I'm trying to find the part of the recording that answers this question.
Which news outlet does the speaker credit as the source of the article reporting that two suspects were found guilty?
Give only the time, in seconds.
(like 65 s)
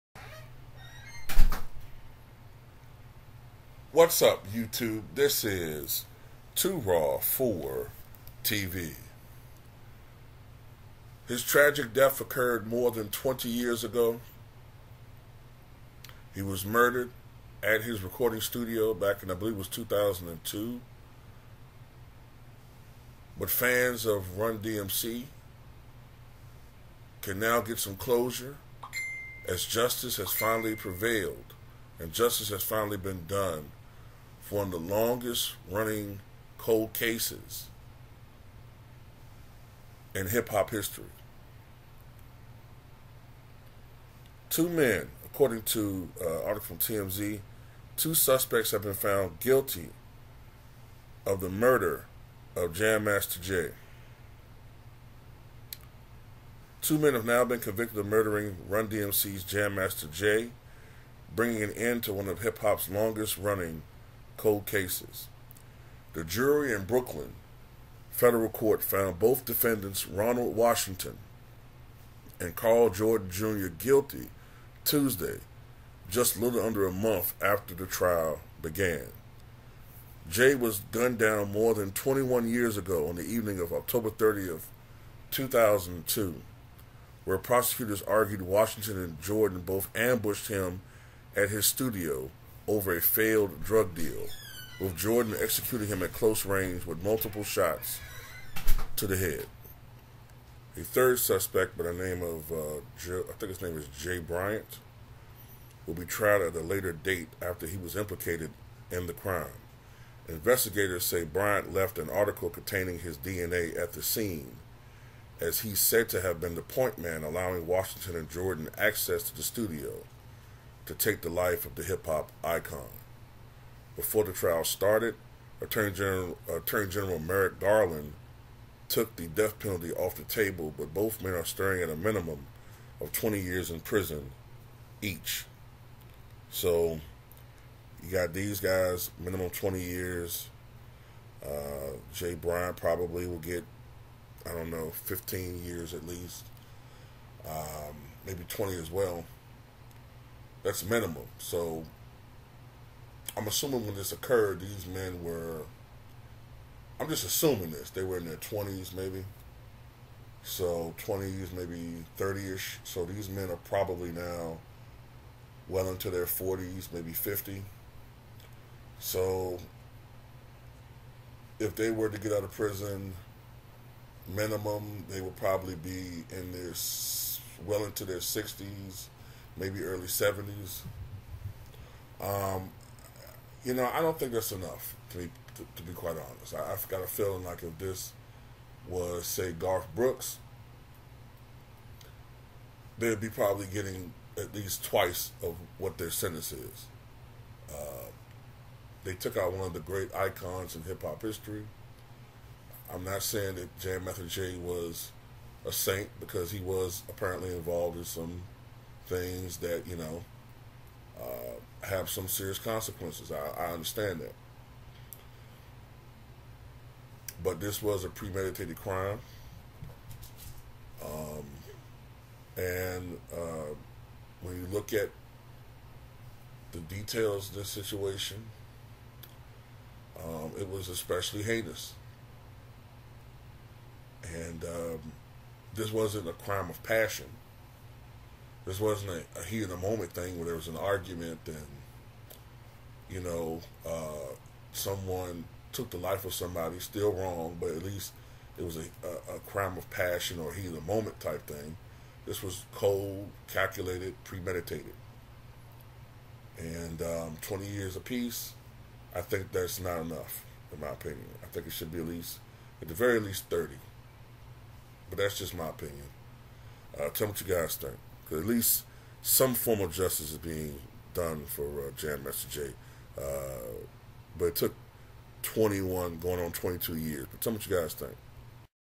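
46 s.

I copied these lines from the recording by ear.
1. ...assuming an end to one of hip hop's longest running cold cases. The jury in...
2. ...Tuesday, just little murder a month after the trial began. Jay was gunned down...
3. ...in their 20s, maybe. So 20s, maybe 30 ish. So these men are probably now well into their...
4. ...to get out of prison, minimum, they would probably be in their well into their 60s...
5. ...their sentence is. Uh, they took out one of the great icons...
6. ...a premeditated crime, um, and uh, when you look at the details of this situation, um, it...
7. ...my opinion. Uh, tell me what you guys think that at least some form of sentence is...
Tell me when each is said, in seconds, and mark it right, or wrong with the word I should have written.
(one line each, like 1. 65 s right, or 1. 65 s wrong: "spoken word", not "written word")
1. 61 s wrong: "bringing", not "assuming"
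2. 74 s wrong: "under", not "murder"
3. 158 s right
4. 172 s right
5. 195 s right
6. 218 s right
7. 265 s wrong: "justice", not "sentence".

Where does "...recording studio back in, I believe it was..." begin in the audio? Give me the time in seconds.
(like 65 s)
18 s.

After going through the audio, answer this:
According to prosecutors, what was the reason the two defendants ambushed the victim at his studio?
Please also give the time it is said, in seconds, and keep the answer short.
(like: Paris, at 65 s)
a failed drug deal, at 93 s.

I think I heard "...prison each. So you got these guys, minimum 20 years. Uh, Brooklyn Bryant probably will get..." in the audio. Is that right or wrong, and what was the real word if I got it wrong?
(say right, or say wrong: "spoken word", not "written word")
wrong: "Jay", not "Brooklyn".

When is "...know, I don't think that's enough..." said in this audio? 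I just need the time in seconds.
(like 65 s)
183 s.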